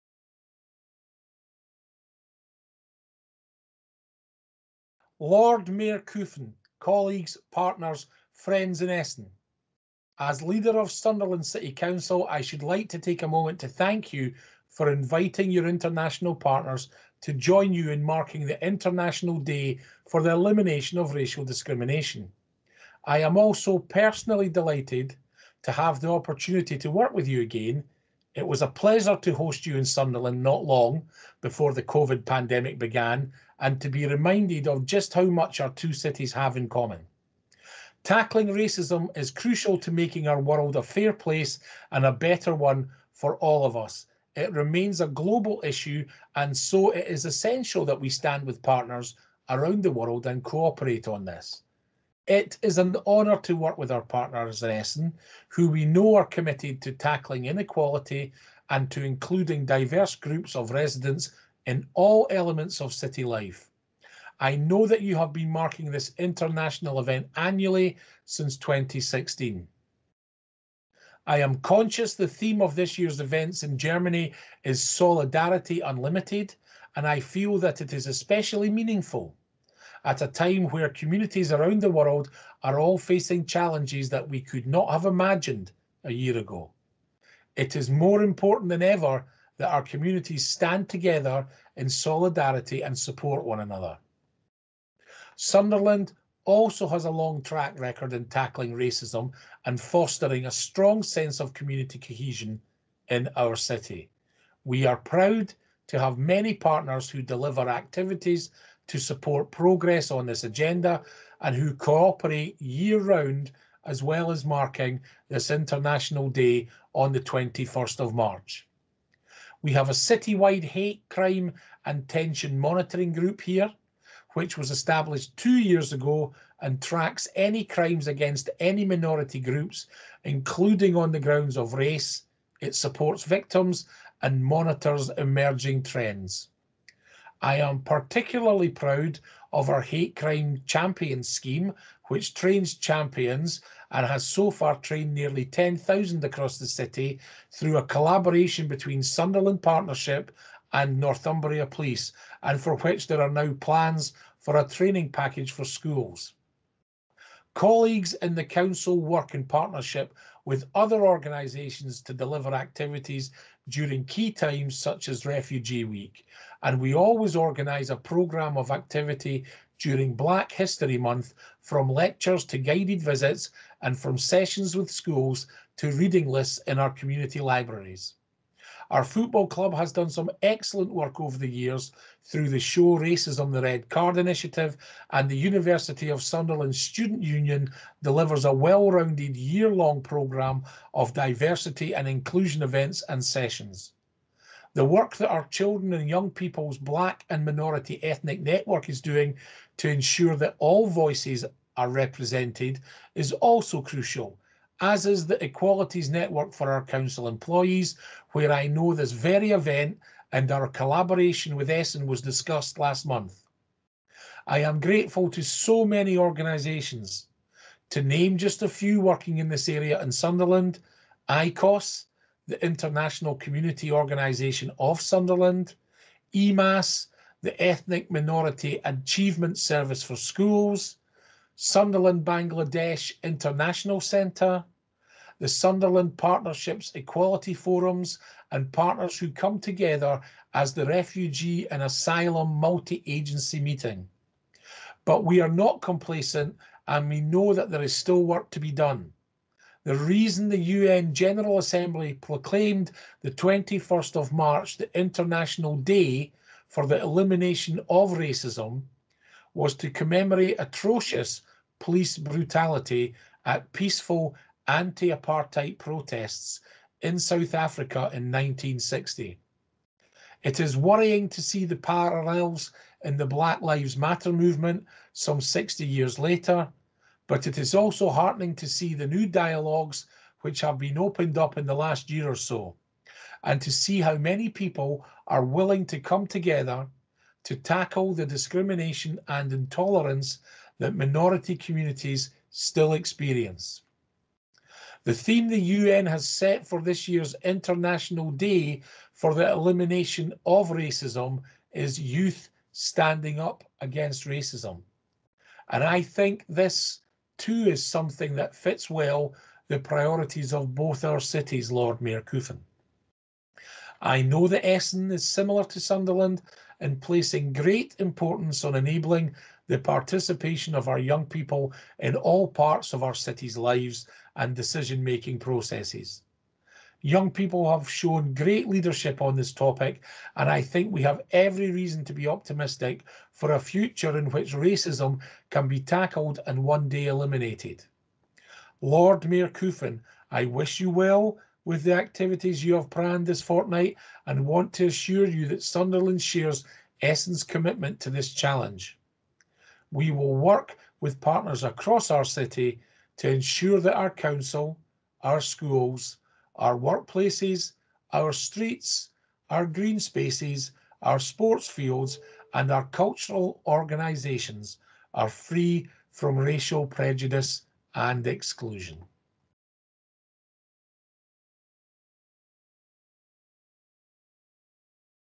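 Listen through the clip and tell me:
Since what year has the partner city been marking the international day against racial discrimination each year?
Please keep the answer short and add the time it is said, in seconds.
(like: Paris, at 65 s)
2016, at 68 s.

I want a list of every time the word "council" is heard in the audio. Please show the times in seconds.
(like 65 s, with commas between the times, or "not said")
11 s, 158 s, 206 s, 354 s.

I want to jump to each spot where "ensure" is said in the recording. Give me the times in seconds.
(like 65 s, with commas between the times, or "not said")
199 s, 353 s.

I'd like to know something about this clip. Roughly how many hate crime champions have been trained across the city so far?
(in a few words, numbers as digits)
10,000.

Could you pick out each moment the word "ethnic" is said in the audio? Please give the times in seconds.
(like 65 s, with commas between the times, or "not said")
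198 s, 227 s.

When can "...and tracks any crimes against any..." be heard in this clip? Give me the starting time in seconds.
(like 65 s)
126 s.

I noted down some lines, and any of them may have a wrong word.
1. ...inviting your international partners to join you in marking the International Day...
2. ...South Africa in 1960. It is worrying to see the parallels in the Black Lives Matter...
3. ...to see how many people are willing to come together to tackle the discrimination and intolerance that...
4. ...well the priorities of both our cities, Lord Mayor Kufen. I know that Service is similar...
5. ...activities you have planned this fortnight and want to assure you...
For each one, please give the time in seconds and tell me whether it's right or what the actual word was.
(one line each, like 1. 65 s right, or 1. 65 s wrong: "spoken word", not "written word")
1. 14 s right
2. 267 s right
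3. 283 s right
4. 308 s wrong: "Essen", not "Service"
5. 341 s right.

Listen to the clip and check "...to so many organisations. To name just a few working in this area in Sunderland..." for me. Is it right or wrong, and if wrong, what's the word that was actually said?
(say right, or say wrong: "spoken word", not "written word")
right.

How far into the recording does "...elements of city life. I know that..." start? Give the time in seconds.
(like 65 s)
62 s.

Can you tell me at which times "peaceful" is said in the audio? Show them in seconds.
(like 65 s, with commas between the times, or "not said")
263 s.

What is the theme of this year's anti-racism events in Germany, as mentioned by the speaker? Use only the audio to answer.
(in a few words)
Solidarity Unlimited.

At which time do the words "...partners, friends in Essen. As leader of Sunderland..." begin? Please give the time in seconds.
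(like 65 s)
7 s.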